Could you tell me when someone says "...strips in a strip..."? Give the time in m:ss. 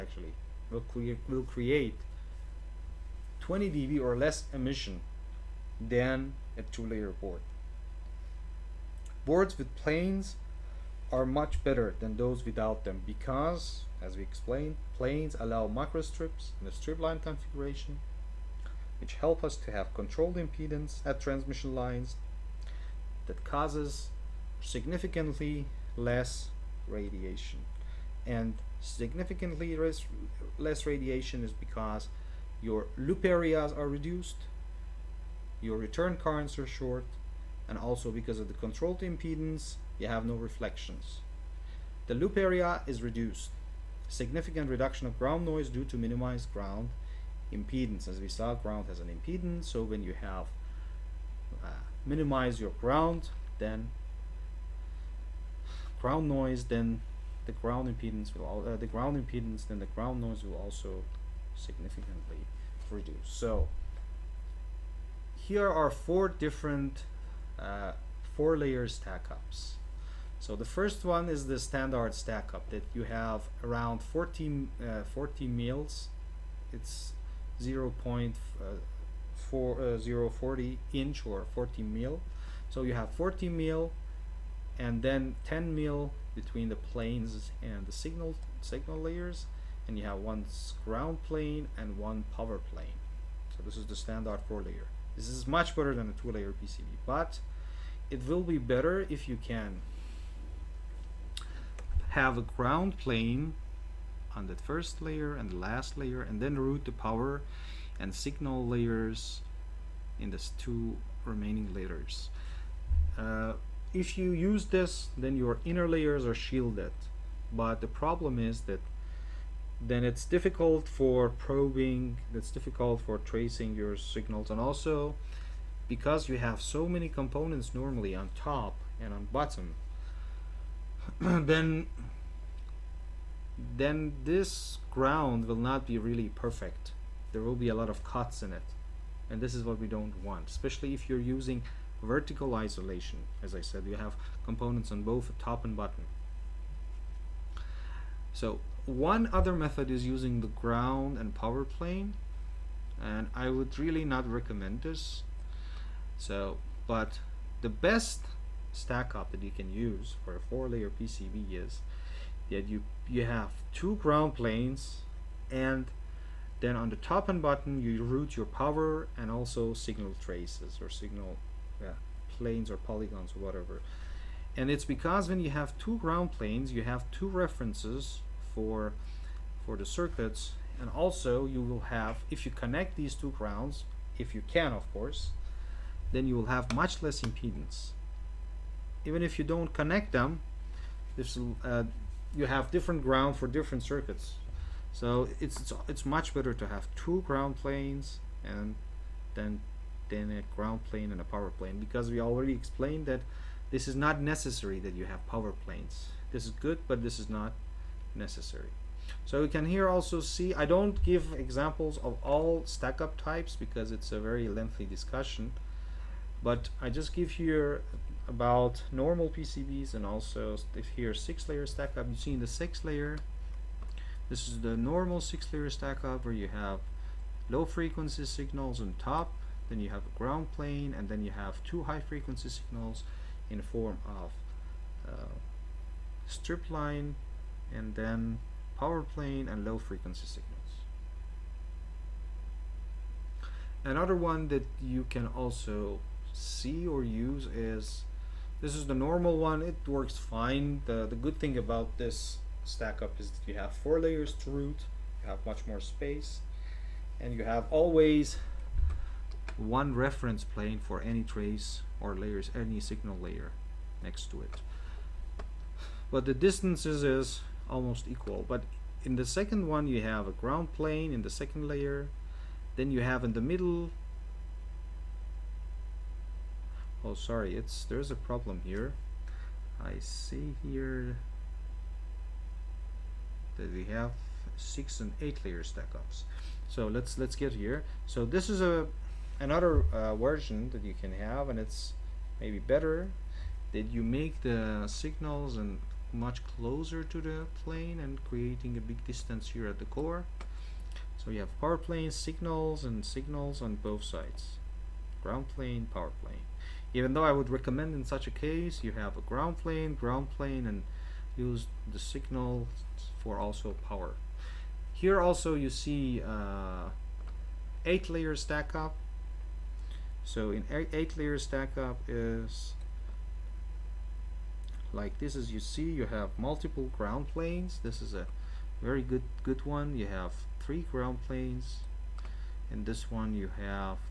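0:16.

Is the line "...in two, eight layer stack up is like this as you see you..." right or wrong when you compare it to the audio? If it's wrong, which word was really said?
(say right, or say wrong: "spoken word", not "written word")
wrong: "eight", not "two".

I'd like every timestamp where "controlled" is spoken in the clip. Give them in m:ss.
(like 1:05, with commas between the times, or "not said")
0:19, 0:38.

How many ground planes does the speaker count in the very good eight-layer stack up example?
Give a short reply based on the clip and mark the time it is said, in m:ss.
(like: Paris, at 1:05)
3, at 5:30.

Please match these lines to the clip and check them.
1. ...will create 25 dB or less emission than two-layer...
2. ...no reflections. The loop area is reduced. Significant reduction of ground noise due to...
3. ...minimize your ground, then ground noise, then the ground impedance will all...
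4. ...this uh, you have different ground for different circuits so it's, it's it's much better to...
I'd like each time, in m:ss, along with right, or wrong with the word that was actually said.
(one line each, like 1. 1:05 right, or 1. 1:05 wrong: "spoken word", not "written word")
1. 0:01 wrong: "20", not "25"
2. 0:40 right
3. 0:52 right
4. 3:11 right.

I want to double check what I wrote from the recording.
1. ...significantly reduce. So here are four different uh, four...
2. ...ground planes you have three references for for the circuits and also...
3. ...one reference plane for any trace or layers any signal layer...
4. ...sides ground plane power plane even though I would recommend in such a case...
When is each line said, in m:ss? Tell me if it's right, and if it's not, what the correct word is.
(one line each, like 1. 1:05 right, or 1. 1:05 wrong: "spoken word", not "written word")
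1. 1:01 right
2. 2:55 wrong: "two", not "three"
3. 4:19 right
4. 5:04 right.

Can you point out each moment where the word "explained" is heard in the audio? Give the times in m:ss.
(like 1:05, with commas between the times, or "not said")
0:14, 3:22.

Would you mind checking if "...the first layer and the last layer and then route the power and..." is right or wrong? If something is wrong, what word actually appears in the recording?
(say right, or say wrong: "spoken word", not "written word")
right.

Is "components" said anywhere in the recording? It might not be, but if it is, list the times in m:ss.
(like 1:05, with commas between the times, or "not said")
2:07, 2:24.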